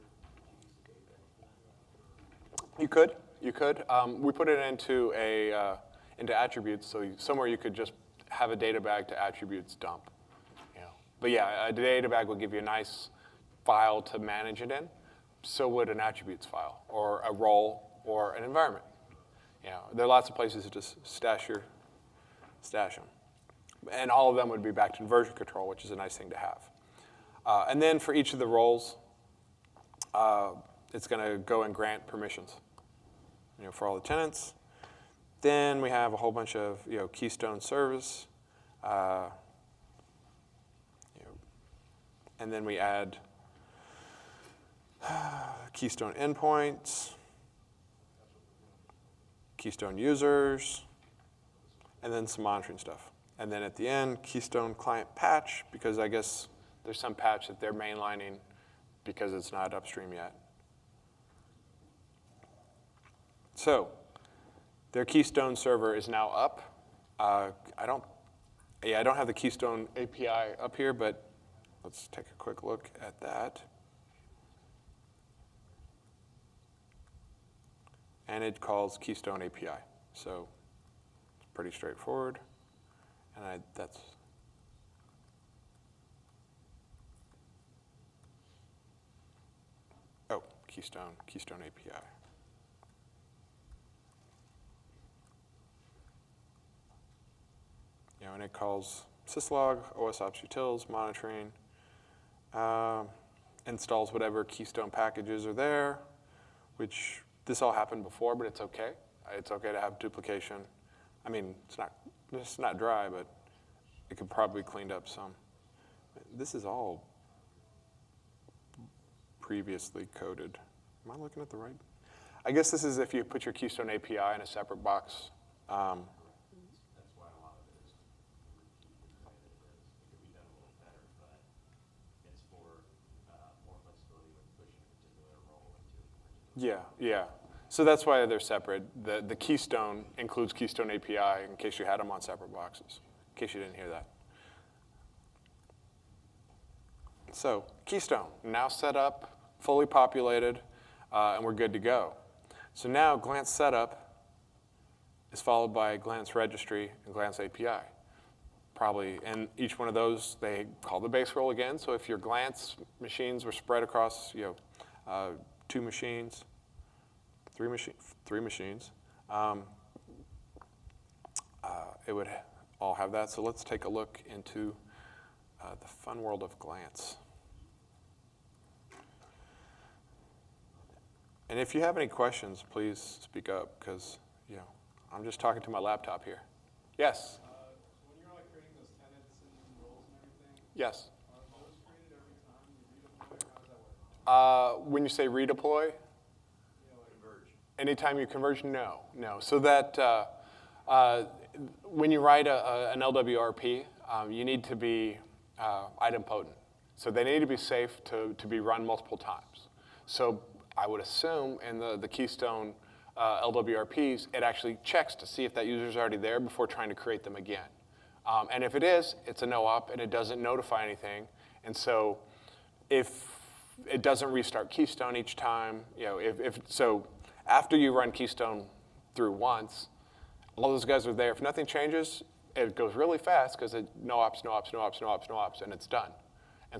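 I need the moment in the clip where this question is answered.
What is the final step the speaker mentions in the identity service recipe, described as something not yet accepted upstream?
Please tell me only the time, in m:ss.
0:54.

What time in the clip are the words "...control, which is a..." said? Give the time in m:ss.
0:25.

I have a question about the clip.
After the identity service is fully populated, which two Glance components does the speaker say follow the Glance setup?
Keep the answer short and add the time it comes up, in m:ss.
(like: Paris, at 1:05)
Glance registry and Glance API, at 2:35.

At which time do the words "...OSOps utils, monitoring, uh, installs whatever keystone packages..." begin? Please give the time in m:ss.
1:39.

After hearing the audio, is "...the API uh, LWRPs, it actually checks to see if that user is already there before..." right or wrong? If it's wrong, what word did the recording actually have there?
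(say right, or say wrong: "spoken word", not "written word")
wrong: "Keystone", not "API".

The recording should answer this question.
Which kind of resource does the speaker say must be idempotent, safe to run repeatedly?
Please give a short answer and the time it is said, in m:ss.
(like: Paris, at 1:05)
LWRP, at 3:23.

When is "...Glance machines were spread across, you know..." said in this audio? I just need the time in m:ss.
2:42.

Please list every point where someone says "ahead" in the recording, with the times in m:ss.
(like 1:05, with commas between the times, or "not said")
not said.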